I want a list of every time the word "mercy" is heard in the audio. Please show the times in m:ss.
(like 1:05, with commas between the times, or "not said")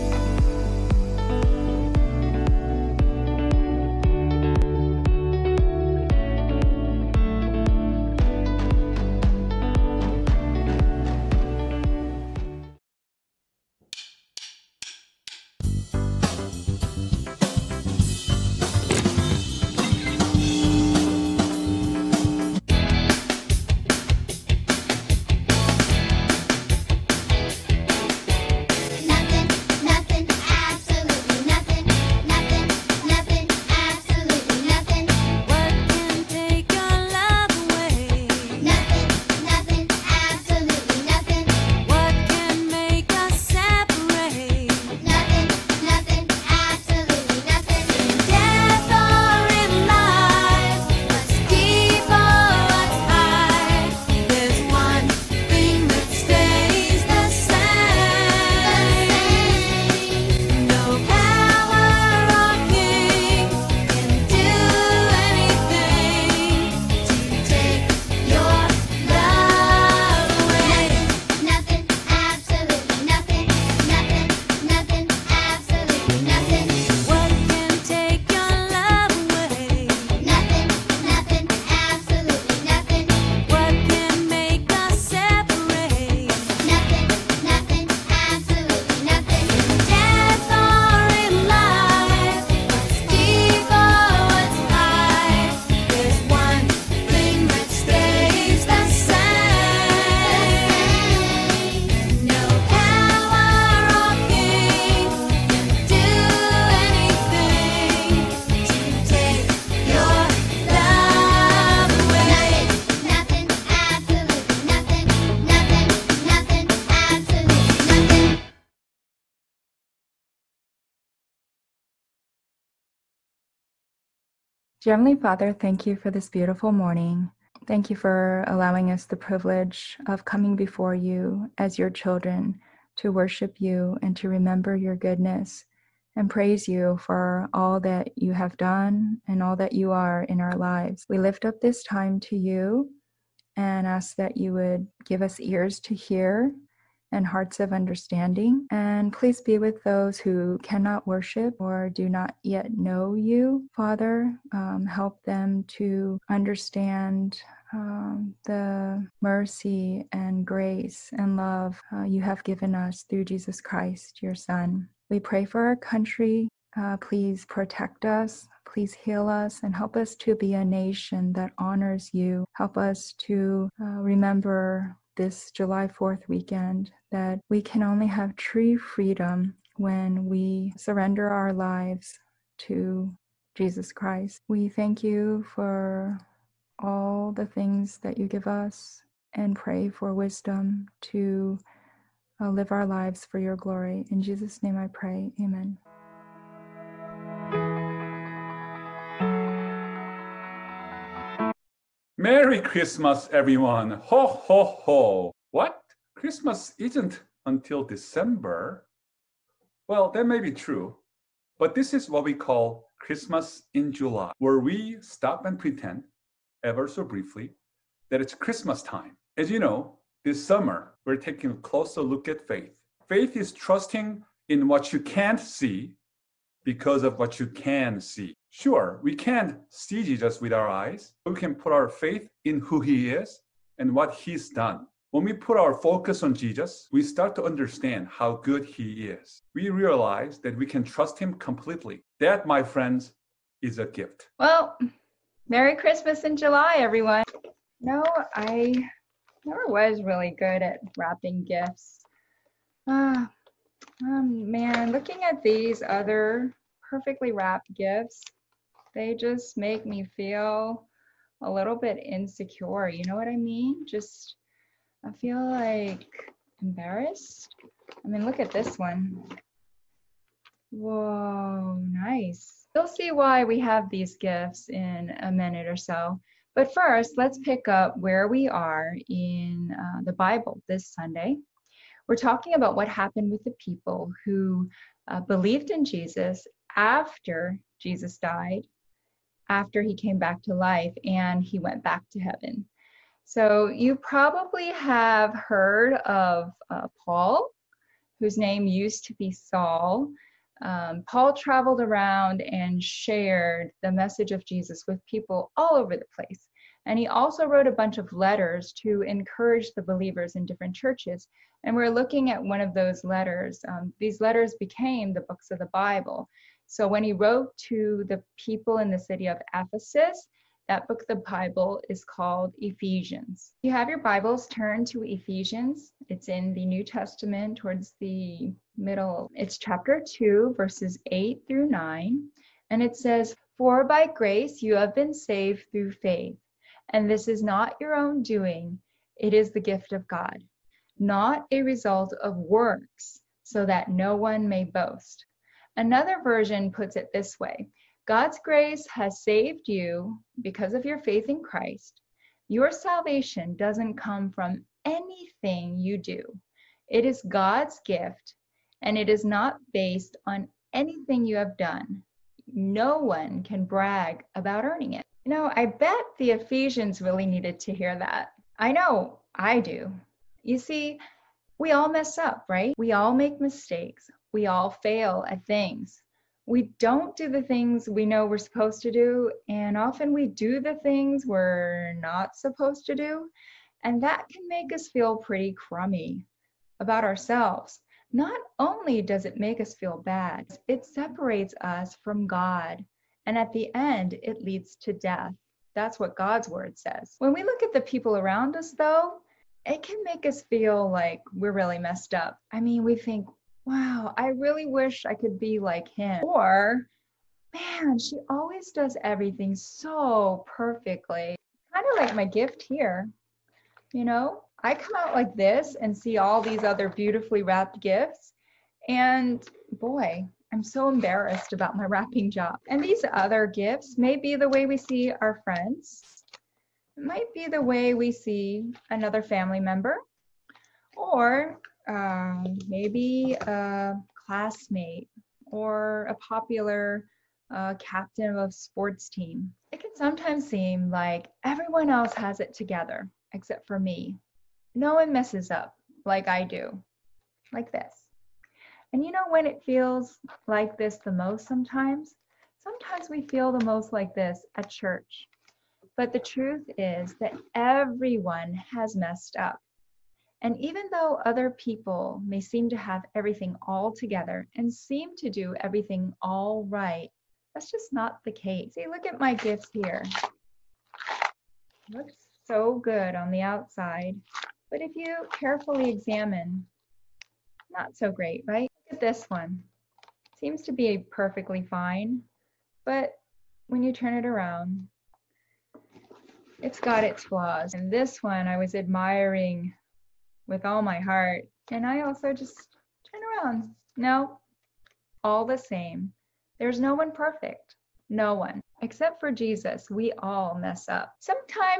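2:39.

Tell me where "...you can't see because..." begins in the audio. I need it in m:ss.
3:44.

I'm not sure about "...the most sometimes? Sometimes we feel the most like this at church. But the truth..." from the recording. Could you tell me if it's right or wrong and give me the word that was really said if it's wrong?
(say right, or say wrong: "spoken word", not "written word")
right.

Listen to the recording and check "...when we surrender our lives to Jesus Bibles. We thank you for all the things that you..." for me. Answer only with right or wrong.
wrong.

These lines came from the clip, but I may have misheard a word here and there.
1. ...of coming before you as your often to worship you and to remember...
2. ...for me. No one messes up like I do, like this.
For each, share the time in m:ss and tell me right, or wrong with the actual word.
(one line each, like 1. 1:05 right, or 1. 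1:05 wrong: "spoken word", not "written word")
1. 2:10 wrong: "children", not "often"
2. 7:23 right.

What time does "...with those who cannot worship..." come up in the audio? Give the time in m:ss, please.
2:29.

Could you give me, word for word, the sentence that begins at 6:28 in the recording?
Not only does it make us feel bad, it separates us from God, and at the end, it leads to death.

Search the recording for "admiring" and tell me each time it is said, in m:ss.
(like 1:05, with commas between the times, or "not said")
8:08.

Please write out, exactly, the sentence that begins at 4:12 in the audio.
Ah, oh man, looking at these other perfectly wrapped gifts they just make me feel a little bit insecure.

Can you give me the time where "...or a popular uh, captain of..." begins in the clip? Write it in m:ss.
7:15.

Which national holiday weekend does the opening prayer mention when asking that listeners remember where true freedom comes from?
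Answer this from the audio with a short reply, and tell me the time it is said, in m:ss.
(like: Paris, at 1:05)
July 4th, at 2:55.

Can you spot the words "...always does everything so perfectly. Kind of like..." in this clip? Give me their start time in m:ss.
6:48.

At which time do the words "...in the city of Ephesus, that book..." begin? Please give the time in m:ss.
5:18.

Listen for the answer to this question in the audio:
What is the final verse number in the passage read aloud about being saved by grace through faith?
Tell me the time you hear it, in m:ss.
5:31.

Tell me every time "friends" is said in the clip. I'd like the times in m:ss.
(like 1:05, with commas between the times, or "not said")
4:02, 7:05.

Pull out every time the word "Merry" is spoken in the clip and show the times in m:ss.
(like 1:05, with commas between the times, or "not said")
3:22, 4:05.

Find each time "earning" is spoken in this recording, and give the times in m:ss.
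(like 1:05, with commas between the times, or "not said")
6:04.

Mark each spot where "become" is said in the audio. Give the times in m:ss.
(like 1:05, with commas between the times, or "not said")
not said.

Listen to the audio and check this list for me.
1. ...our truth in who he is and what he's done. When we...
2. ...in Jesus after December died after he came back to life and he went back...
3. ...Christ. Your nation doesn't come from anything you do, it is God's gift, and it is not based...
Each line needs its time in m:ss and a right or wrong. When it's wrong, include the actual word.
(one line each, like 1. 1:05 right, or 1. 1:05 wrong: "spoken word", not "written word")
1. 3:51 wrong: "faith", not "truth"
2. 4:45 wrong: "Jesus", not "December"
3. 5:51 wrong: "salvation", not "nation".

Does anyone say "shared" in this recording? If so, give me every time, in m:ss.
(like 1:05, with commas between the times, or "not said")
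5:02.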